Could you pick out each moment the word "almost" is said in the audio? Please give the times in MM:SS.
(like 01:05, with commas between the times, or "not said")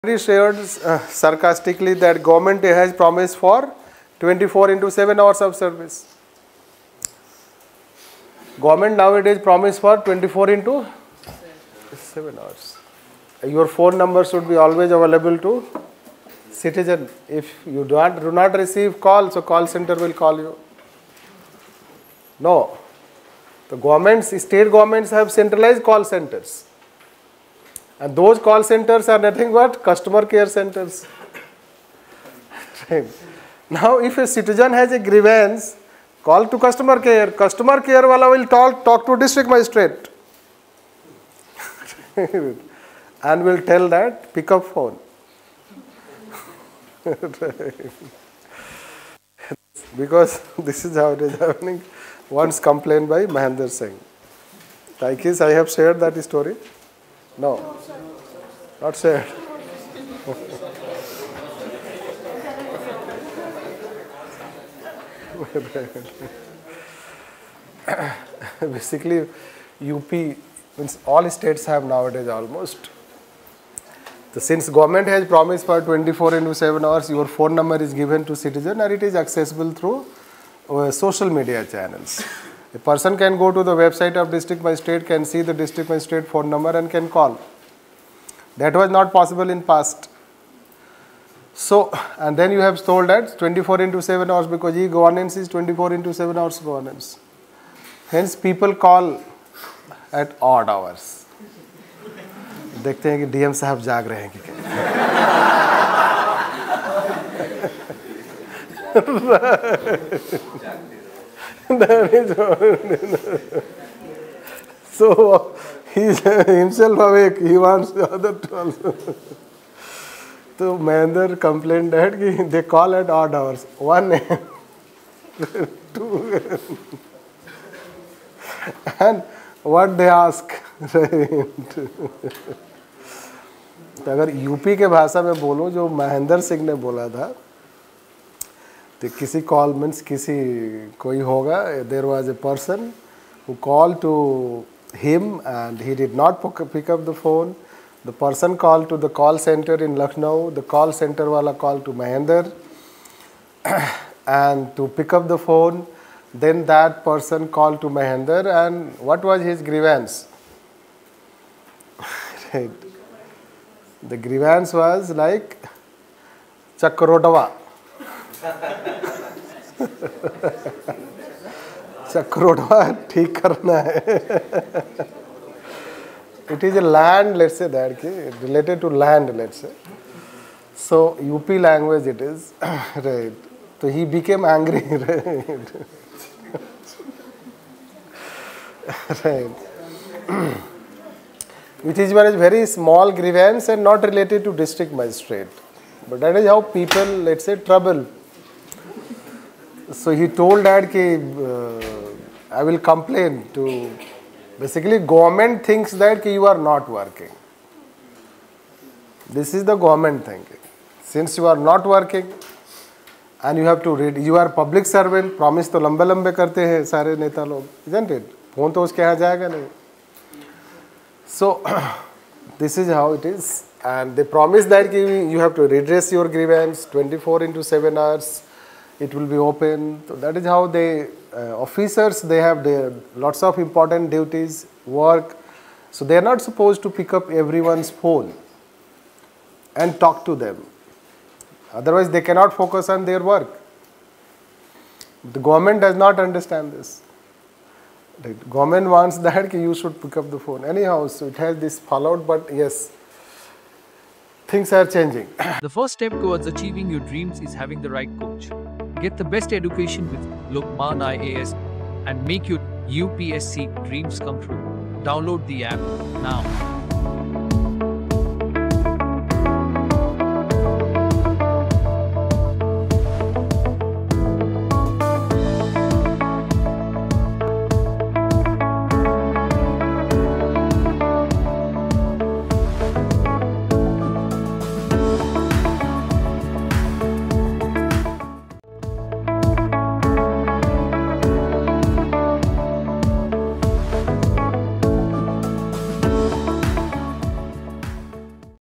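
01:12.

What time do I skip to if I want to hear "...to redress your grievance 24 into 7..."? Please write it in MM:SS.
03:45.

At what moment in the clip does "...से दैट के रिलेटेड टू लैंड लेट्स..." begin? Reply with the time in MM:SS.
02:57.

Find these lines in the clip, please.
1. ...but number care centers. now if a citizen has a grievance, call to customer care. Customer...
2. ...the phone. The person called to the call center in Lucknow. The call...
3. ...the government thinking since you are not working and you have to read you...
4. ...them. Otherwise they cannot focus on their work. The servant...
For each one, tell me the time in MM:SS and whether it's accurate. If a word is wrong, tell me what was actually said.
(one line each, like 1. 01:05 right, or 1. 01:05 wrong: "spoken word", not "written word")
1. 00:29 wrong: "customer", not "number"
2. 02:27 right
3. 03:29 right
4. 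04:00 wrong: "government", not "servant".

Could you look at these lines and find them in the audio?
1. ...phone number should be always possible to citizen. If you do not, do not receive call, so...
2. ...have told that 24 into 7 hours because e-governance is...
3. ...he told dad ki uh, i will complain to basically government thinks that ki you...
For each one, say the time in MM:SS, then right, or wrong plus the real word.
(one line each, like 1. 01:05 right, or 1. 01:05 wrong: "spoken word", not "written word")
1. 00:13 wrong: "available", not "possible"
2. 01:32 right
3. 03:20 right.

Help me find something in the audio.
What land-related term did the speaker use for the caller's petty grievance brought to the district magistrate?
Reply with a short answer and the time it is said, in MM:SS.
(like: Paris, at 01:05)
Chakrodava, at 02:46.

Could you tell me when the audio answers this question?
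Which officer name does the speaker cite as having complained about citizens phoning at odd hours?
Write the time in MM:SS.
00:53.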